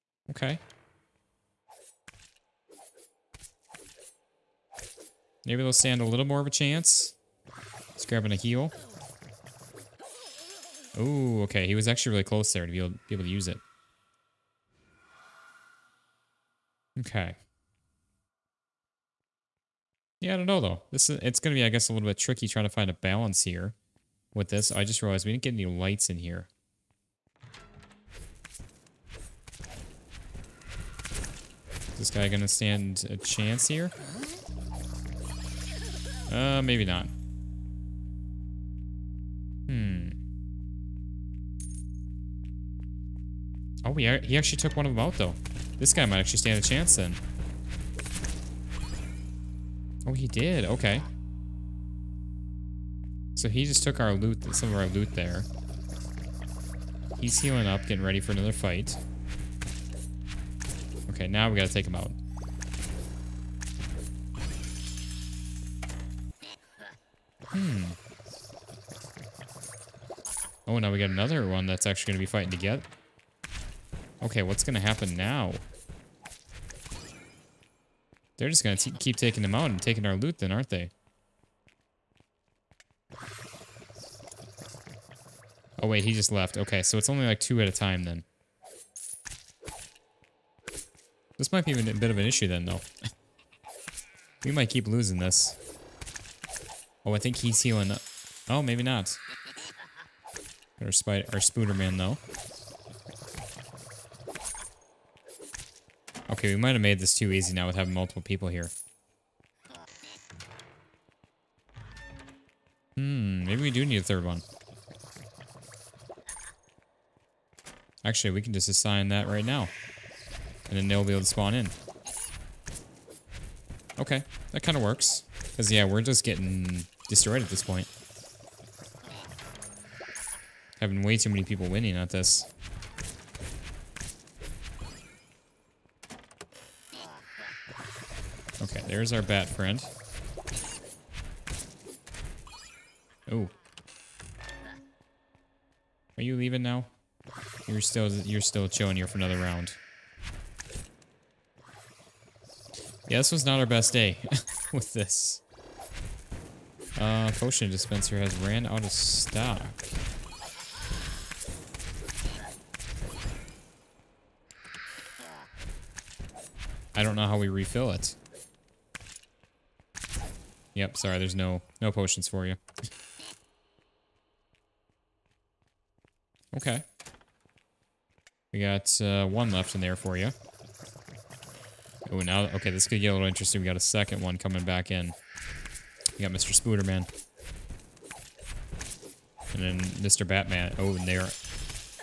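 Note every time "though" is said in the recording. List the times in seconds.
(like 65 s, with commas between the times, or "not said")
20 s, 45 s, 92 s, 101 s.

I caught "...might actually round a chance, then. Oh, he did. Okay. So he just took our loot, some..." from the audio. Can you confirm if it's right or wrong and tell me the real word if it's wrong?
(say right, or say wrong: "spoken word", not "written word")
wrong: "stand", not "round".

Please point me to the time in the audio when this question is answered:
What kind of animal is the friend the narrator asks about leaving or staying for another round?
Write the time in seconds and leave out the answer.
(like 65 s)
139 s.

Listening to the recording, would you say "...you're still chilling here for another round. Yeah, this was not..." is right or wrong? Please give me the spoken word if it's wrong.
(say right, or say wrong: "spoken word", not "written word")
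right.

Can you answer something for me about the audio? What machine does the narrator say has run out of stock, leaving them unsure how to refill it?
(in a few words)
Potion dispenser.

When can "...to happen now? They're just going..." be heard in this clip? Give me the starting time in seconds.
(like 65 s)
74 s.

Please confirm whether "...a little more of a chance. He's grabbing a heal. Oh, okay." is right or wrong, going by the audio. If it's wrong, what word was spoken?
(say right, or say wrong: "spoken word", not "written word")
right.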